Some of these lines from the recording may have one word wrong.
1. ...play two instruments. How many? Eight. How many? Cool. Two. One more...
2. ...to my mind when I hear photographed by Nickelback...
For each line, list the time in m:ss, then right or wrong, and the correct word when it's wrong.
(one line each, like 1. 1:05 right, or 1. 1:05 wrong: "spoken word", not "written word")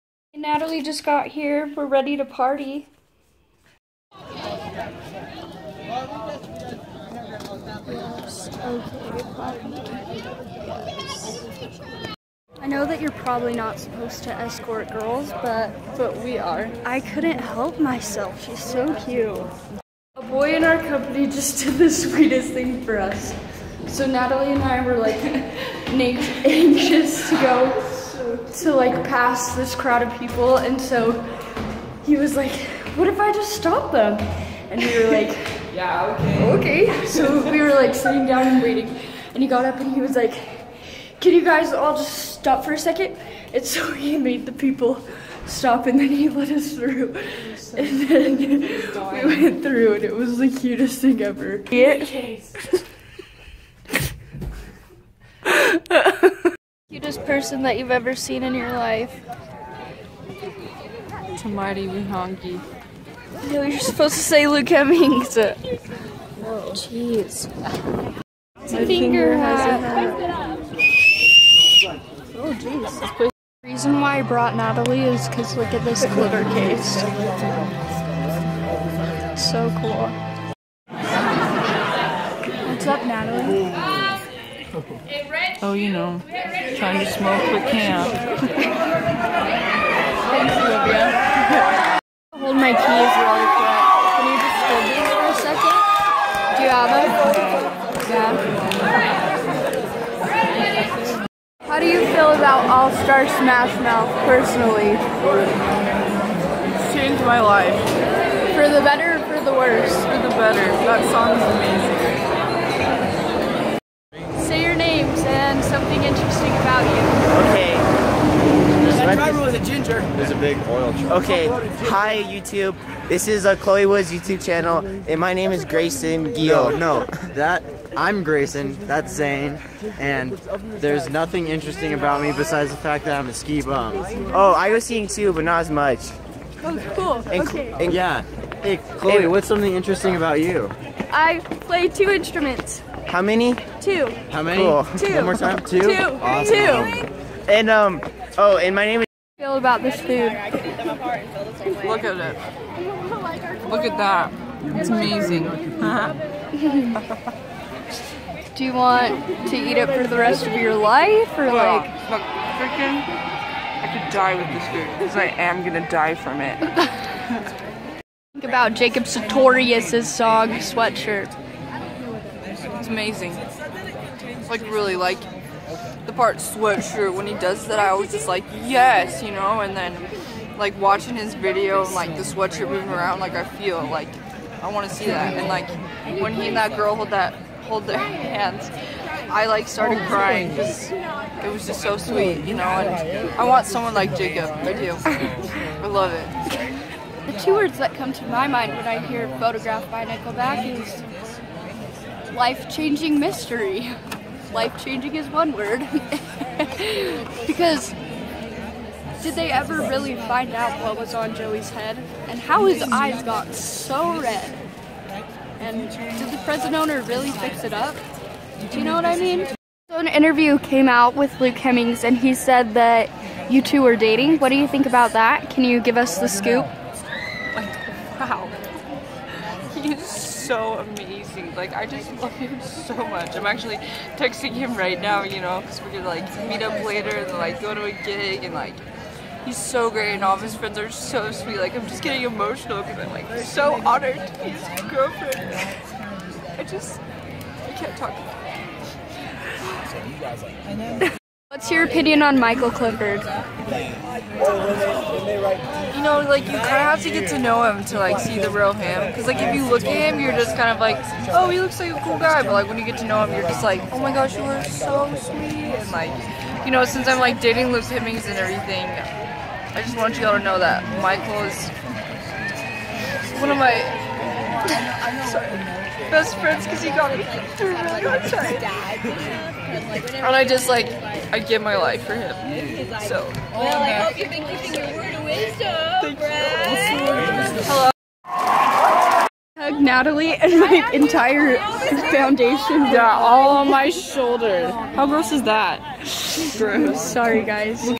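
1. 2:21 wrong: "Two", not "Eight"
2. 3:18 right.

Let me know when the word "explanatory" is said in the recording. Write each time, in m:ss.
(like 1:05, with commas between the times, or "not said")
not said.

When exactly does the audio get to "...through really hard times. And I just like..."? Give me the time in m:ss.
4:37.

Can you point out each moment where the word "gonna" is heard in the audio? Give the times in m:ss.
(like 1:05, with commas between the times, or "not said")
2:45, 3:55.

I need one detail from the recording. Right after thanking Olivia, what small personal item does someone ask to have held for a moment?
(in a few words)
Keys.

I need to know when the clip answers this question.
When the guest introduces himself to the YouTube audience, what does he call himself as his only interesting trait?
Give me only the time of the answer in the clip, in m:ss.
2:13.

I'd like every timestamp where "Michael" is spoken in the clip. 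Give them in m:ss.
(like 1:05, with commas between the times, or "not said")
4:12, 4:31.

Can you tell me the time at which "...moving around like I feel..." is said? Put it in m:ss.
3:02.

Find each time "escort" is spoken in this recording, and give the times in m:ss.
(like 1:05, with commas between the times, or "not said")
0:14.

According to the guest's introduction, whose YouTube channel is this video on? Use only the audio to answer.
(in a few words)
Chloe Woods.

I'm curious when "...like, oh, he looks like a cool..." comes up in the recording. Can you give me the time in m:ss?
4:20.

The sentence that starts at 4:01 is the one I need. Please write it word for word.
Like, I'm just getting emotional because I'm like so honored to be his girlfriend.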